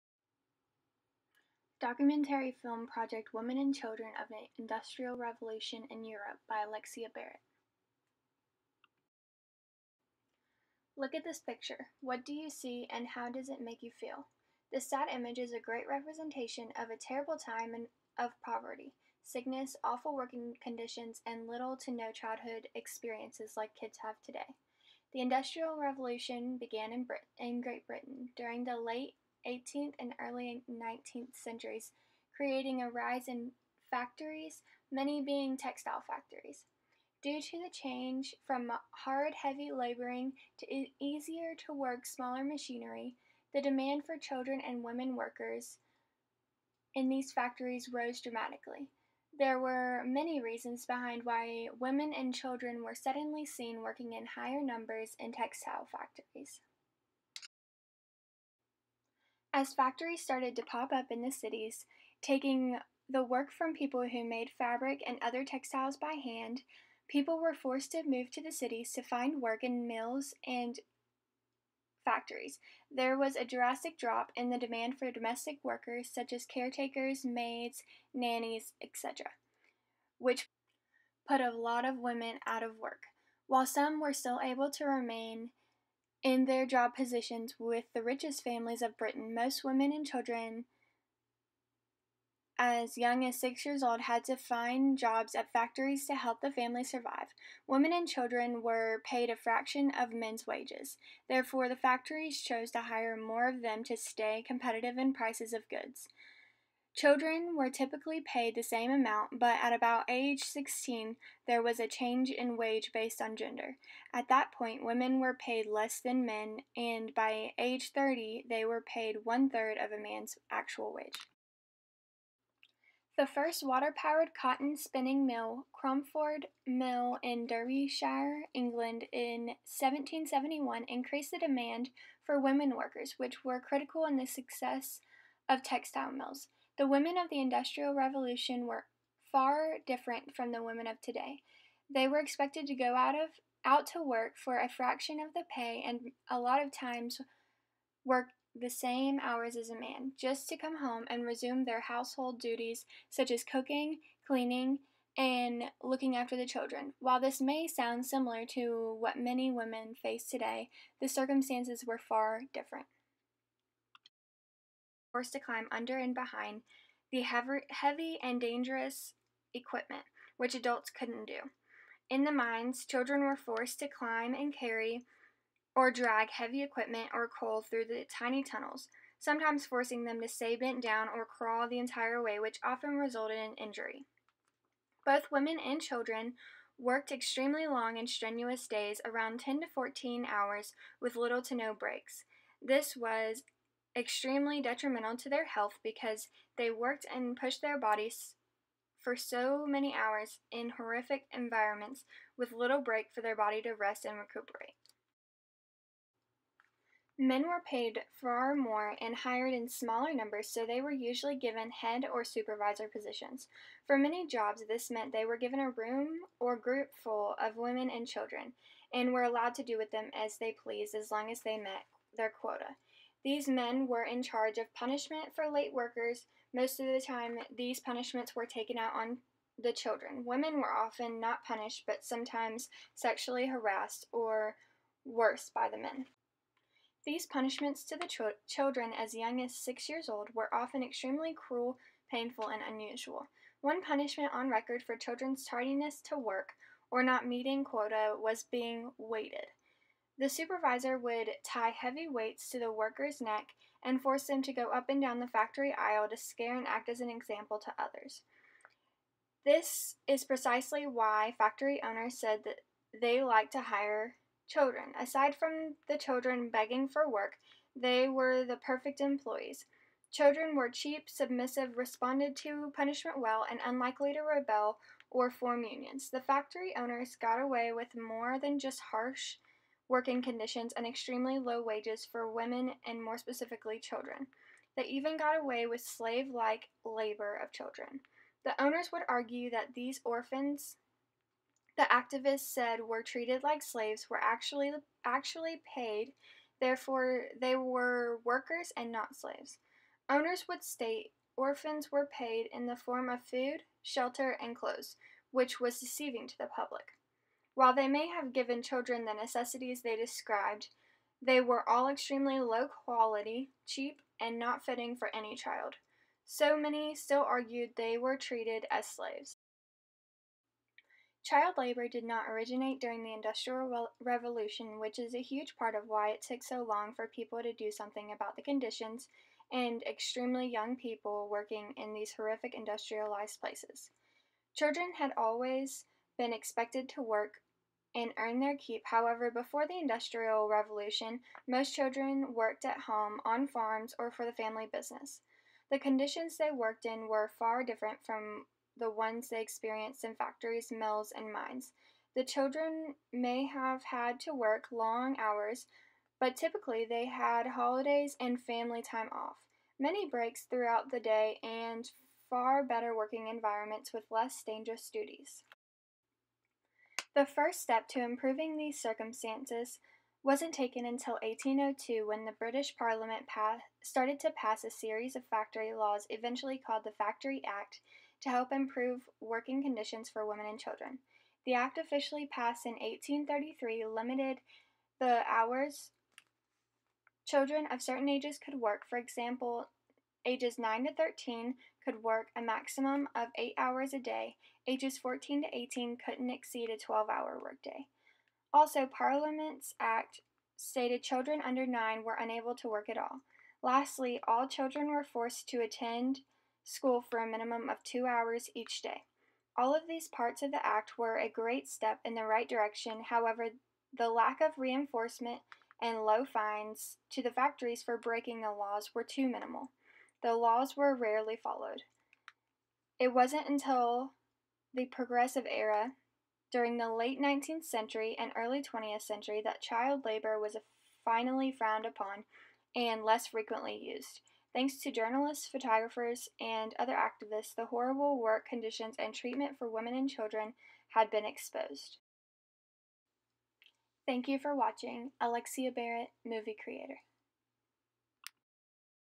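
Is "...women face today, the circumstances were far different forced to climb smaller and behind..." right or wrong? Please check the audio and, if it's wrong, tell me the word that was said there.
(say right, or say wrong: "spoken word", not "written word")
wrong: "under", not "smaller".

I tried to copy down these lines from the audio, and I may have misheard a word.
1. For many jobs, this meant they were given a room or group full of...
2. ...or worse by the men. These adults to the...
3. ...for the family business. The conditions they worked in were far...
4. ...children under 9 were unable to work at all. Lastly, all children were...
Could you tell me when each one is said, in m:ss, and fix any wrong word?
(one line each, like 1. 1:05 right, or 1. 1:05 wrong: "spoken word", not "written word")
1. 3:33 right
2. 3:54 wrong: "punishments", not "adults"
3. 5:44 right
4. 6:41 right.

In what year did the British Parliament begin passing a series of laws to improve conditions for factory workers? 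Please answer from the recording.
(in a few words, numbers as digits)
1802.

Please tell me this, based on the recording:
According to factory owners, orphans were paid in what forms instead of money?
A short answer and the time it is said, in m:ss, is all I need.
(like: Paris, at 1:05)
Food, shelter, and clothes, at 5:03.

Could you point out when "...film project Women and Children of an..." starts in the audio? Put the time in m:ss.
0:02.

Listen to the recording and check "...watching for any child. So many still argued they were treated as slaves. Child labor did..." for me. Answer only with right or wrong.
wrong.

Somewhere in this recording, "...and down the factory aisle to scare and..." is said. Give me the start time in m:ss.
4:14.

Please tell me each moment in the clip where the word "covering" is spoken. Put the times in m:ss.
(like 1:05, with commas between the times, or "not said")
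not said.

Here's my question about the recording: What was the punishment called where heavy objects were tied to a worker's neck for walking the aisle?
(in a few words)
Being weighted.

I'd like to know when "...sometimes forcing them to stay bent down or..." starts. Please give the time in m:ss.
2:59.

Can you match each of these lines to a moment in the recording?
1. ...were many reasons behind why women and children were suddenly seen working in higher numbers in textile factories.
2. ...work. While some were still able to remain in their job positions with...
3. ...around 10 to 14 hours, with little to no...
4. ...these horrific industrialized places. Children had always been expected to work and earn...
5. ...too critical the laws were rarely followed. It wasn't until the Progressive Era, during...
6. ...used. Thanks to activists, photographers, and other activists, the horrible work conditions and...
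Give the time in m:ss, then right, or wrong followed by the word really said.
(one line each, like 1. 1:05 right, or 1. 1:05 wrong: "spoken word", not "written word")
1. 0:49 right
2. 1:22 right
3. 3:09 right
4. 5:31 right
5. 6:59 wrong: "minimal", not "critical"
6. 7:13 wrong: "journalists", not "activists".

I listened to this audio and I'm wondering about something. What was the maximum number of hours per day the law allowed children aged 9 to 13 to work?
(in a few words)
8.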